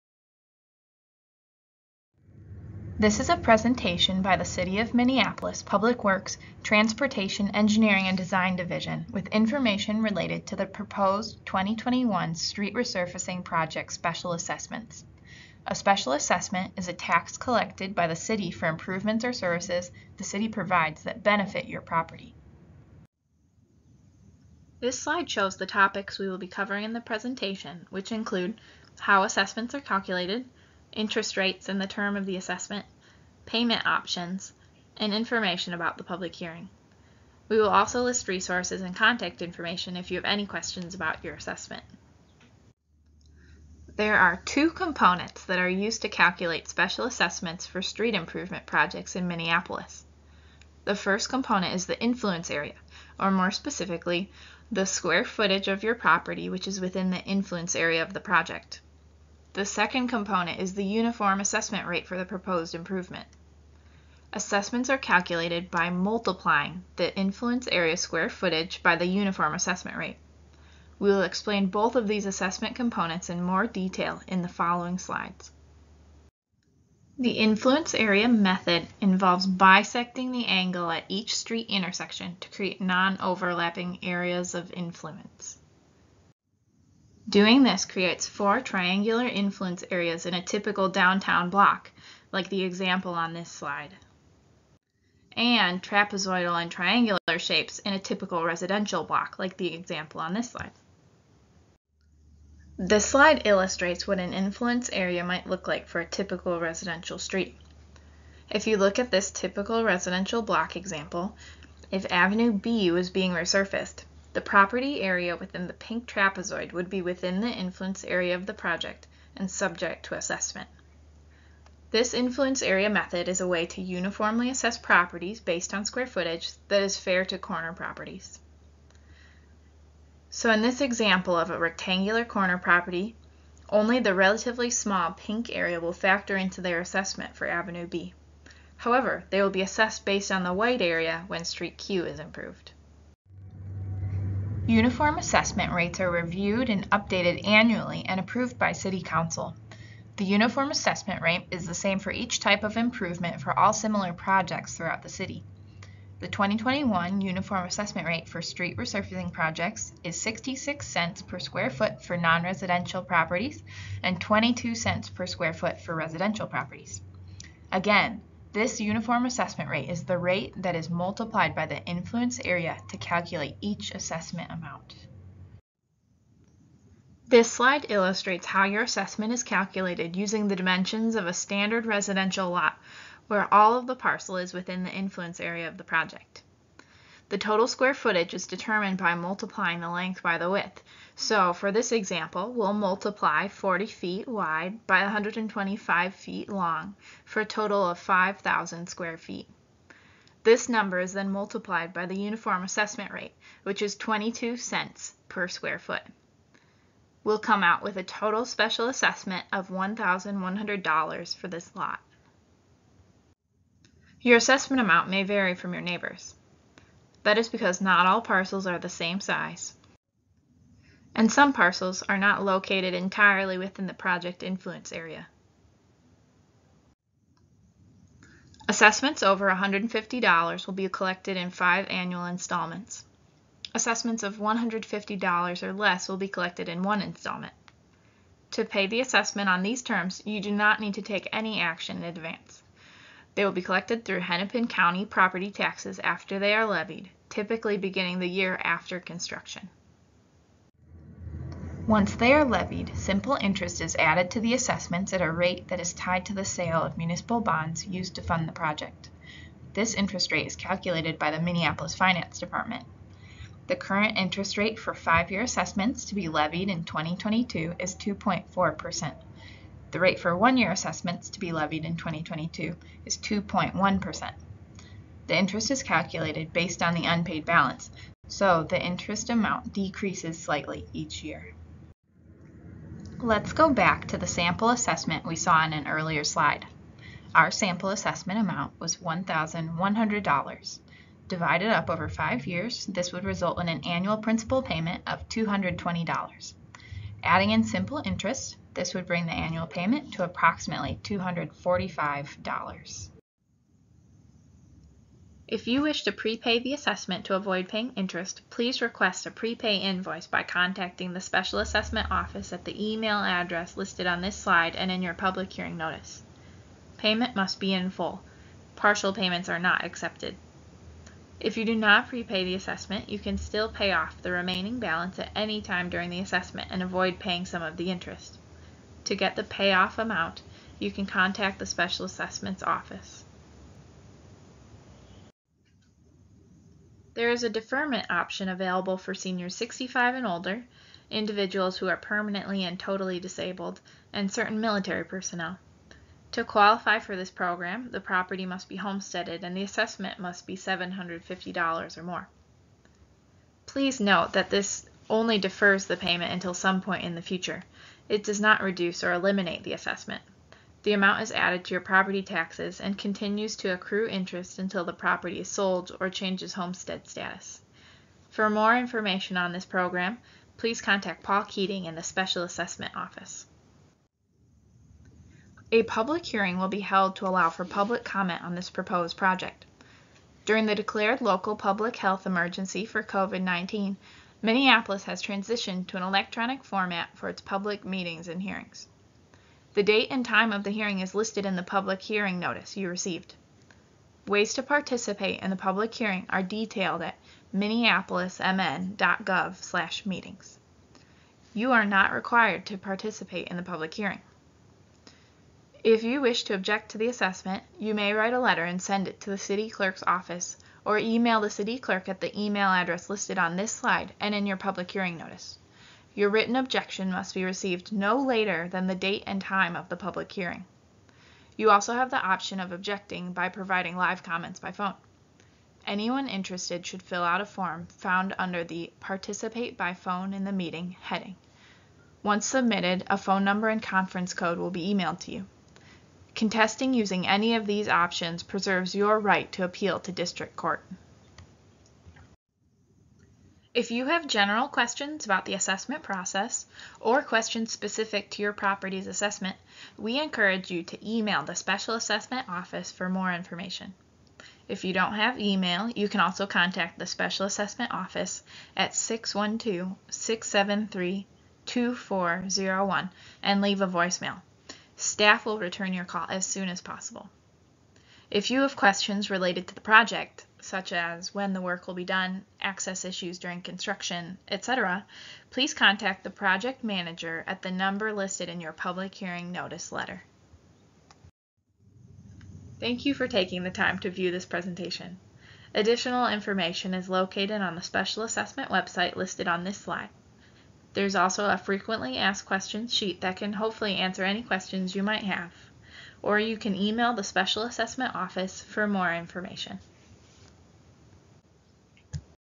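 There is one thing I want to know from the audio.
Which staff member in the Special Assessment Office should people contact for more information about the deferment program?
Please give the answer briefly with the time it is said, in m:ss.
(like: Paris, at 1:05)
Paul Keating, at 6:11.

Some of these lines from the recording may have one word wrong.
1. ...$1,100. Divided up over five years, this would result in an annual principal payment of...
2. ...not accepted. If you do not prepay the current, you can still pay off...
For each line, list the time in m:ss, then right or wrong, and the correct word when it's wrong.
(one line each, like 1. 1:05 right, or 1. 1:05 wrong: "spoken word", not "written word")
1. 4:48 right
2. 5:19 wrong: "assessment", not "current".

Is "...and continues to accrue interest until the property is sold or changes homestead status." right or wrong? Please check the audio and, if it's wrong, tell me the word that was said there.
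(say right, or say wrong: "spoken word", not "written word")
right.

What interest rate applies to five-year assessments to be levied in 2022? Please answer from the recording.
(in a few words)
2.4%.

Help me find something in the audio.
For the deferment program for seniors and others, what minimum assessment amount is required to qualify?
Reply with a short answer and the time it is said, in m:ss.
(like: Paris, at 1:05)
$750, at 5:50.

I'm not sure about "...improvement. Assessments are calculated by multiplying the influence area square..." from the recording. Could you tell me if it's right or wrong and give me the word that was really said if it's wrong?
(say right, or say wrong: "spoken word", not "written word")
right.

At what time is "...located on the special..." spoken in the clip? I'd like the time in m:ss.
8:07.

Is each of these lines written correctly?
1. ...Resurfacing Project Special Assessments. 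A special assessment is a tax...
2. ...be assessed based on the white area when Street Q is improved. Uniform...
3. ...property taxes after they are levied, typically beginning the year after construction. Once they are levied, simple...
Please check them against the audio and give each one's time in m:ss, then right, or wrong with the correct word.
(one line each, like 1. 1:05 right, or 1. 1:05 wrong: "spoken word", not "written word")
1. 0:12 right
2. 2:19 right
3. 4:05 right.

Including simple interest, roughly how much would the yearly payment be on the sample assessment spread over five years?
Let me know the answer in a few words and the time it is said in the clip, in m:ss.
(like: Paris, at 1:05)
$245, at 5:01.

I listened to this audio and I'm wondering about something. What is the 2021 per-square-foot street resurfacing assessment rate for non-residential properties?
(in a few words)
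66 cents.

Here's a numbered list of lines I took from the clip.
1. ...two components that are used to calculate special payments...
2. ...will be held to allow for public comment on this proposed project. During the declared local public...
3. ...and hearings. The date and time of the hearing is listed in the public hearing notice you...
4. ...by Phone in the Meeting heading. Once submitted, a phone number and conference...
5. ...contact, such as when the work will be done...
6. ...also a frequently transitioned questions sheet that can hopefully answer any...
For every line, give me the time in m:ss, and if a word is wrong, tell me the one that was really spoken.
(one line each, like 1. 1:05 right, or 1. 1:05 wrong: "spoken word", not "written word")
1. 0:44 wrong: "assessments", not "payments"
2. 6:16 right
3. 6:28 right
4. 7:09 right
5. 7:49 wrong: "project", not "contact"
6. 8:11 wrong: "asked", not "transitioned".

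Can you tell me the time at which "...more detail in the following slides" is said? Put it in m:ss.
1:13.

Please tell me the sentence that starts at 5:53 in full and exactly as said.
Please note that this only defers the payment until some point in the future.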